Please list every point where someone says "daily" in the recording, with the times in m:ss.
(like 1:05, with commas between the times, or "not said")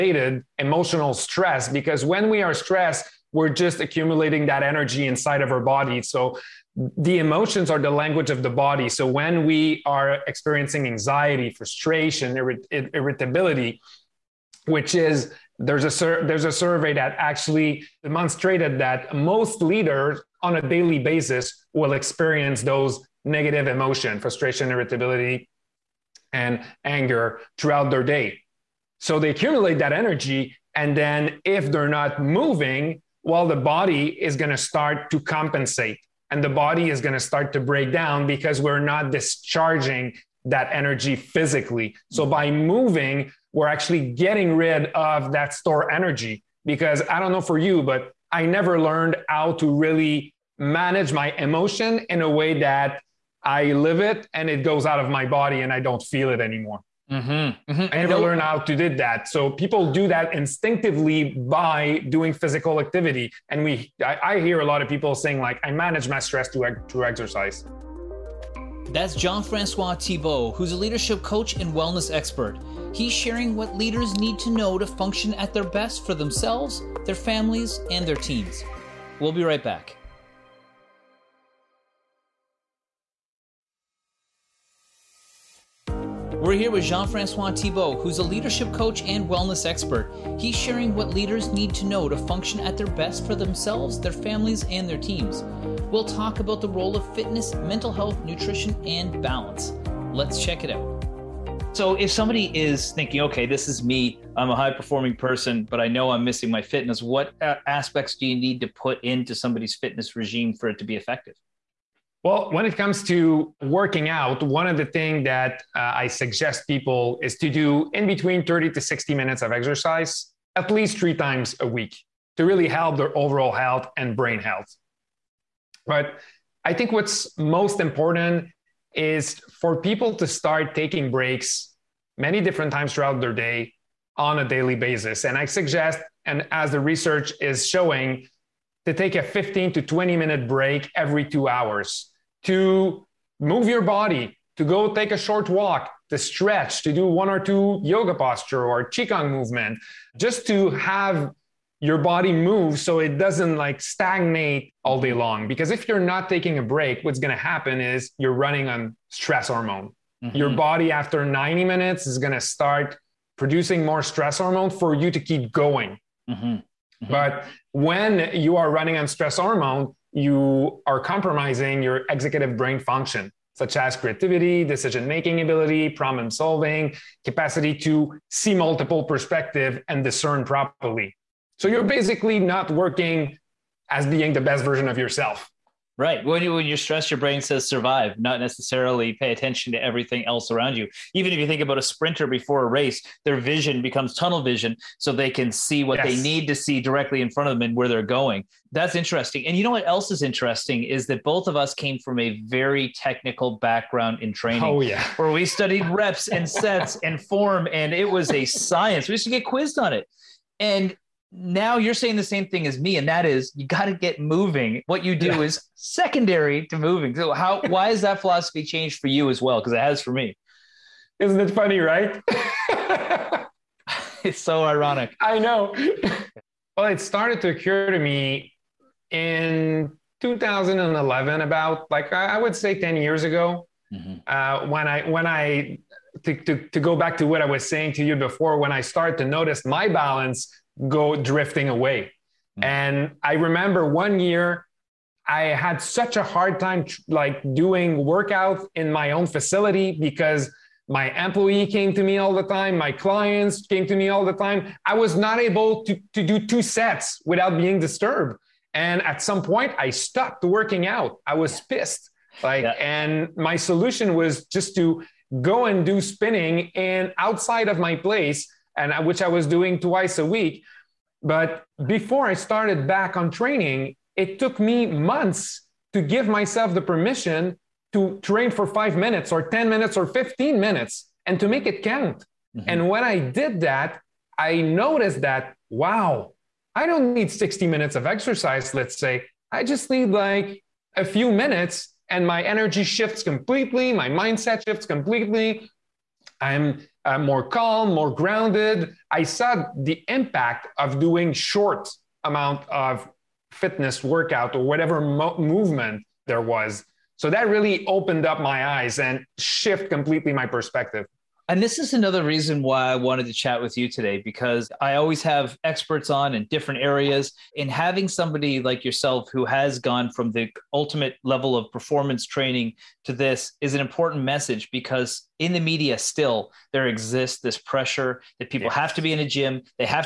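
0:20, 2:14.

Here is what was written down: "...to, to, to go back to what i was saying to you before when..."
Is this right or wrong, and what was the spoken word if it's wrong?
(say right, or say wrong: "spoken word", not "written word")
right.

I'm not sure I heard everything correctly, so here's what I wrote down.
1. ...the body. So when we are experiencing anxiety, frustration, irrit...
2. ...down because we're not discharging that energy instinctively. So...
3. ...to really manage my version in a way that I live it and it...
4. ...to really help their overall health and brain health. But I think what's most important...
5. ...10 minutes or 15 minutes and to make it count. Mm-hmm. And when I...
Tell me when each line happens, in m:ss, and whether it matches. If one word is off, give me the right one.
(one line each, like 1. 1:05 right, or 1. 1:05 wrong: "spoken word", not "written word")
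1. 0:08 right
2. 0:37 wrong: "physically", not "instinctively"
3. 0:49 wrong: "emotion", not "version"
4. 2:02 right
5. 4:39 right.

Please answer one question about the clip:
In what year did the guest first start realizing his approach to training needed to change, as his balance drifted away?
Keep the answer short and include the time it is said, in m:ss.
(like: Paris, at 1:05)
2011, at 3:50.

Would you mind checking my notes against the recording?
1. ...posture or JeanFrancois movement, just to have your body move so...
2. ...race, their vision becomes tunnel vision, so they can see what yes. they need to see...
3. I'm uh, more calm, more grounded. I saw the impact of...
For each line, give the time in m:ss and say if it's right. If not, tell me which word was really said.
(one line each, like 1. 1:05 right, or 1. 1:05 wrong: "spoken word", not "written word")
1. 2:28 wrong: "Qigong", not "JeanFrancois"
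2. 3:12 right
3. 4:56 right.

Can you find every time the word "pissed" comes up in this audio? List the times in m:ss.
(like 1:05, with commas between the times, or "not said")
4:21.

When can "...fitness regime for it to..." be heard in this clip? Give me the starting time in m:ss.
1:49.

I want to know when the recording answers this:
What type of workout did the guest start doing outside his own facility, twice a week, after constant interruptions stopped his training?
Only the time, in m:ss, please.
4:26.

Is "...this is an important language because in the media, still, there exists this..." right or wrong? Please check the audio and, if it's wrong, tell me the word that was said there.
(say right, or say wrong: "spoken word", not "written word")
wrong: "message", not "language".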